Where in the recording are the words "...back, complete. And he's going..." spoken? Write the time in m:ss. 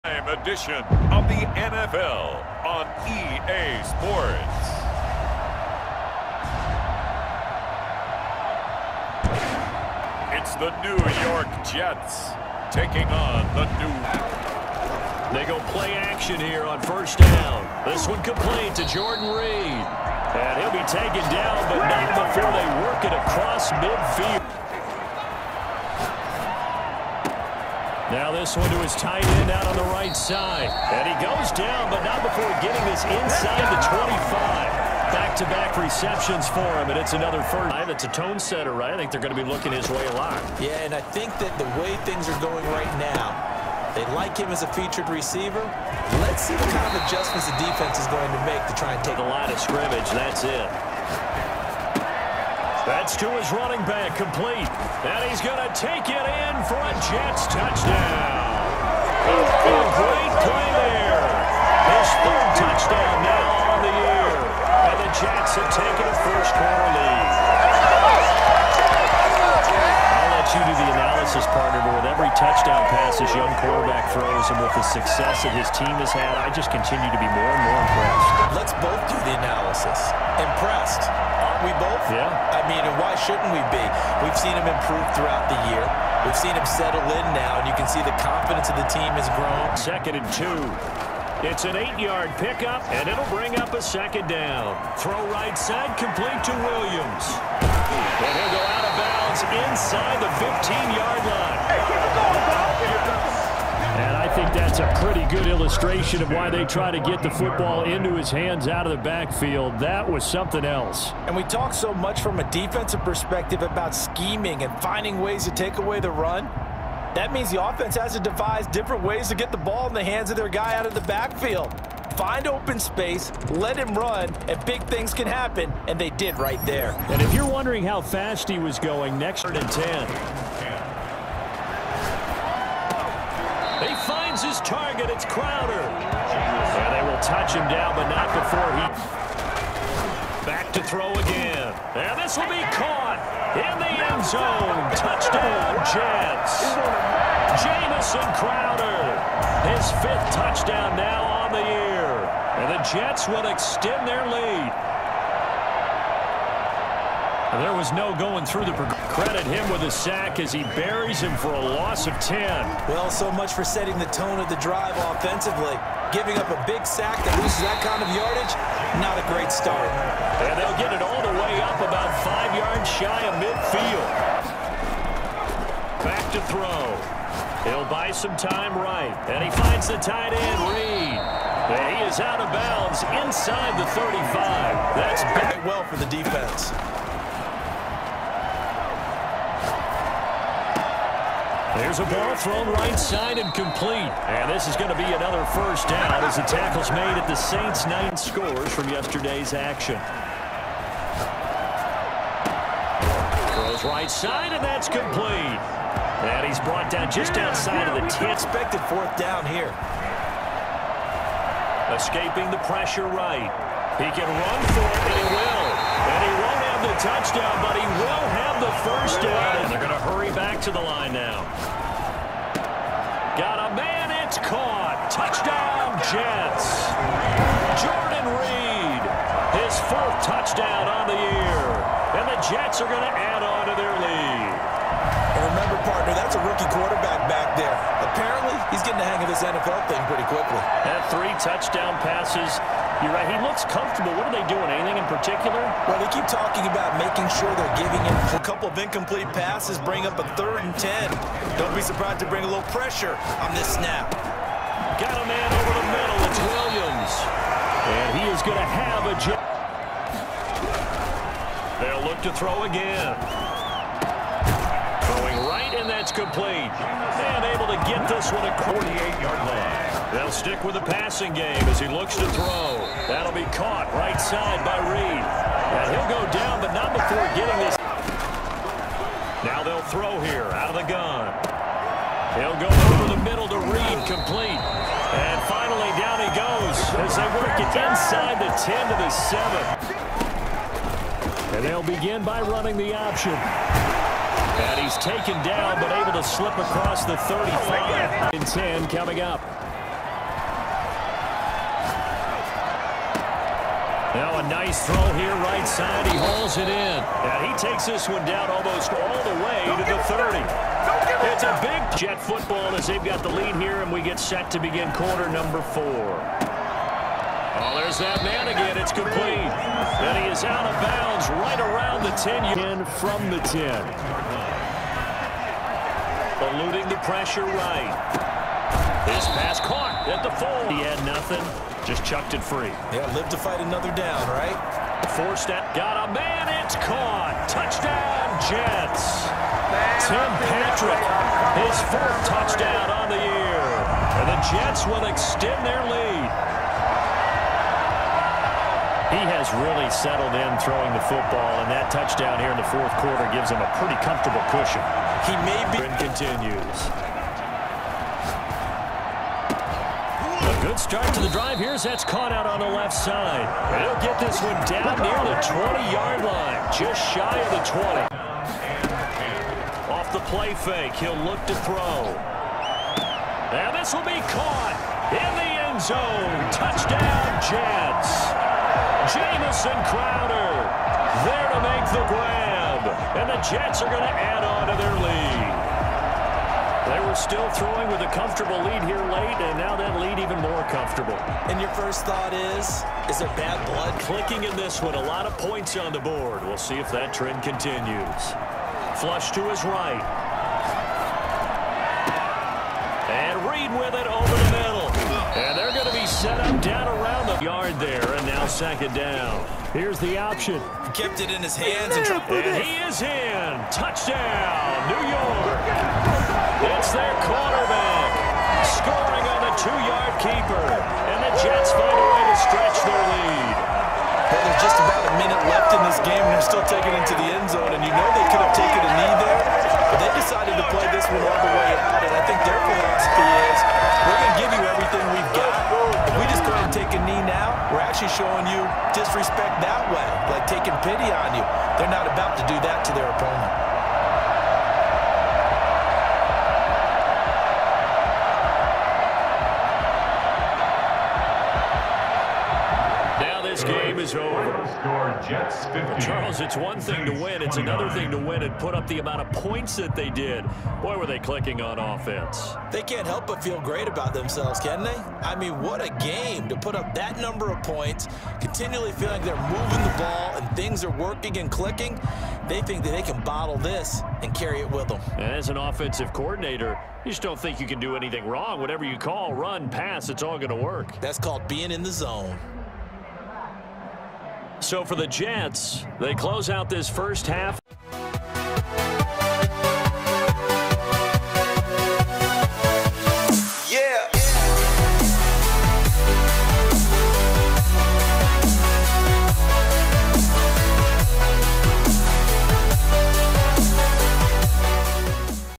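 0:53.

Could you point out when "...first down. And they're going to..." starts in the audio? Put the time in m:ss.
3:38.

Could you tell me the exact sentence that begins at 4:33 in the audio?
That'll be caught right side by Reed.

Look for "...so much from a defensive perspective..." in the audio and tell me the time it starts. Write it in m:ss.
1:51.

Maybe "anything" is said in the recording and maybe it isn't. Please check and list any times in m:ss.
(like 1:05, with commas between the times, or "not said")
4:04, 7:57.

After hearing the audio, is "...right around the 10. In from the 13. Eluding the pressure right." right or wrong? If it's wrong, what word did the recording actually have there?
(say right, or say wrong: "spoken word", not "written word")
wrong: "10", not "13".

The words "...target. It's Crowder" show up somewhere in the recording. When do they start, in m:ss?
2:14.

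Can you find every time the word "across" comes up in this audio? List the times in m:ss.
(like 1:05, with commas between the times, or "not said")
0:23, 4:56.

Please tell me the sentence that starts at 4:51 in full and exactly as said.
And they'll begin by running the option.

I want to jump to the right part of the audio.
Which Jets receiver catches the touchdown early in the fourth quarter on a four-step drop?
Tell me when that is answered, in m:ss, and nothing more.
5:40.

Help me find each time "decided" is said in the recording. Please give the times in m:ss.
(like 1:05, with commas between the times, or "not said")
7:10.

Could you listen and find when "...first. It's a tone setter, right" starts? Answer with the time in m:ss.
0:37.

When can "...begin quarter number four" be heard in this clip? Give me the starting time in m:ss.
5:14.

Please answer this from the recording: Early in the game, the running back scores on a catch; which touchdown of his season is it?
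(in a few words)
3rd.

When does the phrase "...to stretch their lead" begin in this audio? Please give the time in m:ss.
7:02.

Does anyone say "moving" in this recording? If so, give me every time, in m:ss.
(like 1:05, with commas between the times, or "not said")
7:49.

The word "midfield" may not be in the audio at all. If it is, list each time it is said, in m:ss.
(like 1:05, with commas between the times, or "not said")
0:23, 2:53.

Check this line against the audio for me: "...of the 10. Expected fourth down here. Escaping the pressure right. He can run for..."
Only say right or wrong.
right.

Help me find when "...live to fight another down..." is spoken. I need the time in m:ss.
5:33.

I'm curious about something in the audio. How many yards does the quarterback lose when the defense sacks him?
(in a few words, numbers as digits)
10.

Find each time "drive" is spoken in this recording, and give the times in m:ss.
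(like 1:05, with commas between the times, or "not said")
2:44, 6:01.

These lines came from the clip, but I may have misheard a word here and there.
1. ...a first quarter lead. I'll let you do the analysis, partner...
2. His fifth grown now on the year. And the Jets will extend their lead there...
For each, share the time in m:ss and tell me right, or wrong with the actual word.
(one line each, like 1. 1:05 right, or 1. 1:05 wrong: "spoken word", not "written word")
1. 1:06 right
2. 2:29 wrong: "touchdown", not "grown".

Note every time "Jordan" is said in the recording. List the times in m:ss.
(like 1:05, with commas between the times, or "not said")
0:18, 3:47.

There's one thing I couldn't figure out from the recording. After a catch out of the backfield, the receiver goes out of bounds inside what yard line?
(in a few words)
15.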